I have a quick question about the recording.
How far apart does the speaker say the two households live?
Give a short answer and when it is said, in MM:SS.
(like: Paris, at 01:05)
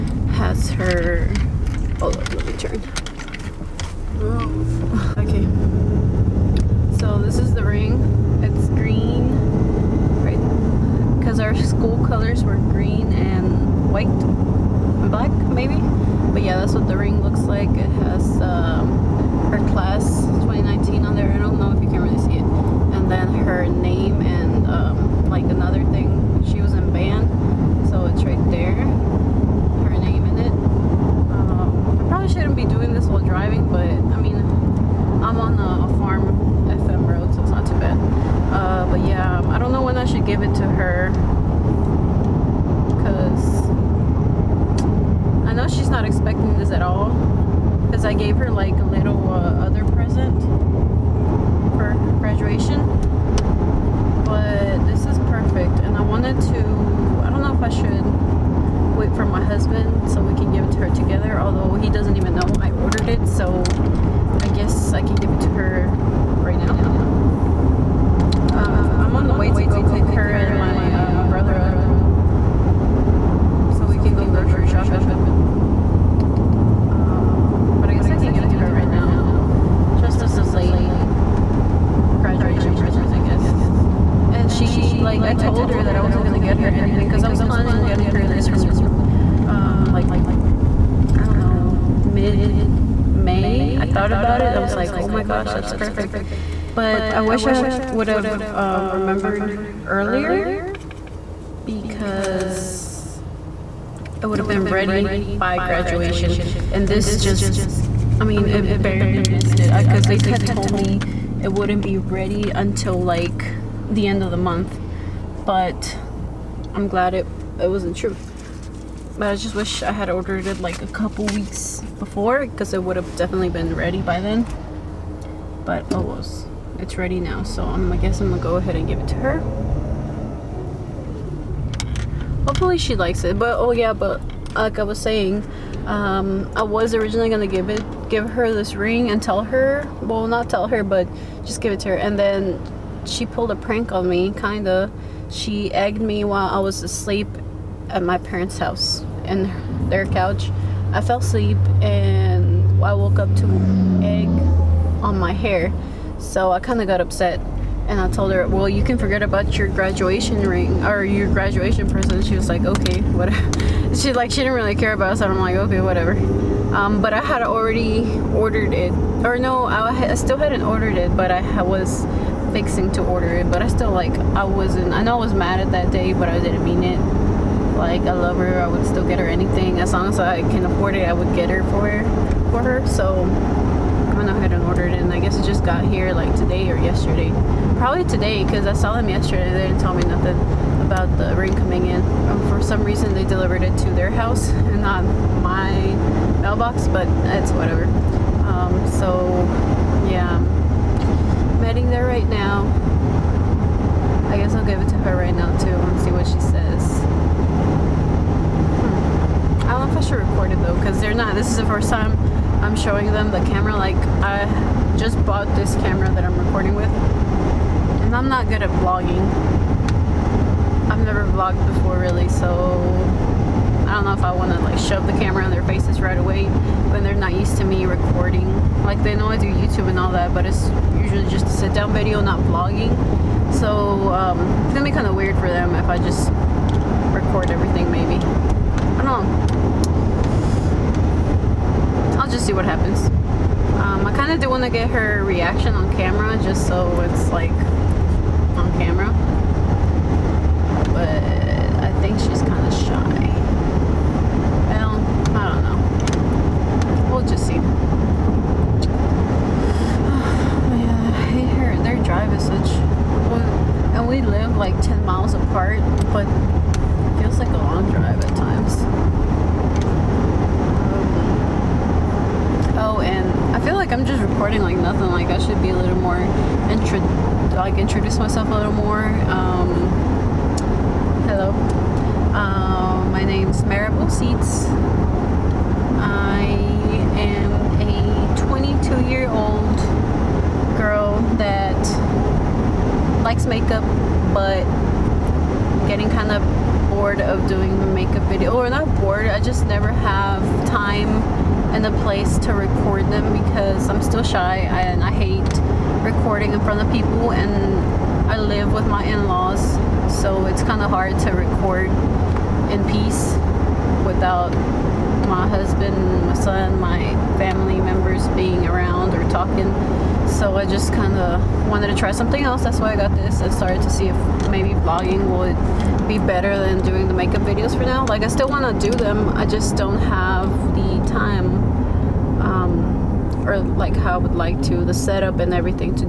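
10 miles, at 04:24.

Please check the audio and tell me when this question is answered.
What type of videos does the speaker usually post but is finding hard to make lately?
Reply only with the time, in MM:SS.
04:57.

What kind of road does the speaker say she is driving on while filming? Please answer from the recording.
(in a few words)
FM road.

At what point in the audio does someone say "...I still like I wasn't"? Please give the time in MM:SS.
02:53.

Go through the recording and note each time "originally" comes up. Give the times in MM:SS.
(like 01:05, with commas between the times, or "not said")
02:16.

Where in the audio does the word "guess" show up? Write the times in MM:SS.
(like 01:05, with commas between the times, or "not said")
01:04, 02:07, 03:05.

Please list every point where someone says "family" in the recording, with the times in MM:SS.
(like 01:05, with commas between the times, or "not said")
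05:17.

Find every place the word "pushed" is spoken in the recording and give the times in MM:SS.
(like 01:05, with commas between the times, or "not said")
not said.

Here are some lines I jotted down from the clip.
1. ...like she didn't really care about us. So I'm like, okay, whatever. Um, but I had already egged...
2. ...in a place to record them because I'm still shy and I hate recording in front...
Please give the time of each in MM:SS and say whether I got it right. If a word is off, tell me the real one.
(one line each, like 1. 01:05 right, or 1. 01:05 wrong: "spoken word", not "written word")
1. 02:44 wrong: "ordered", not "egged"
2. 05:01 right.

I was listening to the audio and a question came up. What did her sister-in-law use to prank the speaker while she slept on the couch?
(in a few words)
Egg.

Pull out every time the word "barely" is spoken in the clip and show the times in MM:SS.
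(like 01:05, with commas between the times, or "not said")
01:48.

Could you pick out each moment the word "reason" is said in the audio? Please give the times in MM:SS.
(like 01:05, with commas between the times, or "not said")
03:12.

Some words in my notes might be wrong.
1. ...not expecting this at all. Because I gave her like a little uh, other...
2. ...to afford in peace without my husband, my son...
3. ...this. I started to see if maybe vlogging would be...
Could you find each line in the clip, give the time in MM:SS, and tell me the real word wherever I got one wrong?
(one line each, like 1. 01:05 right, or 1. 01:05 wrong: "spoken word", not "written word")
1. 00:45 right
2. 05:11 wrong: "record", not "afford"
3. 05:23 right.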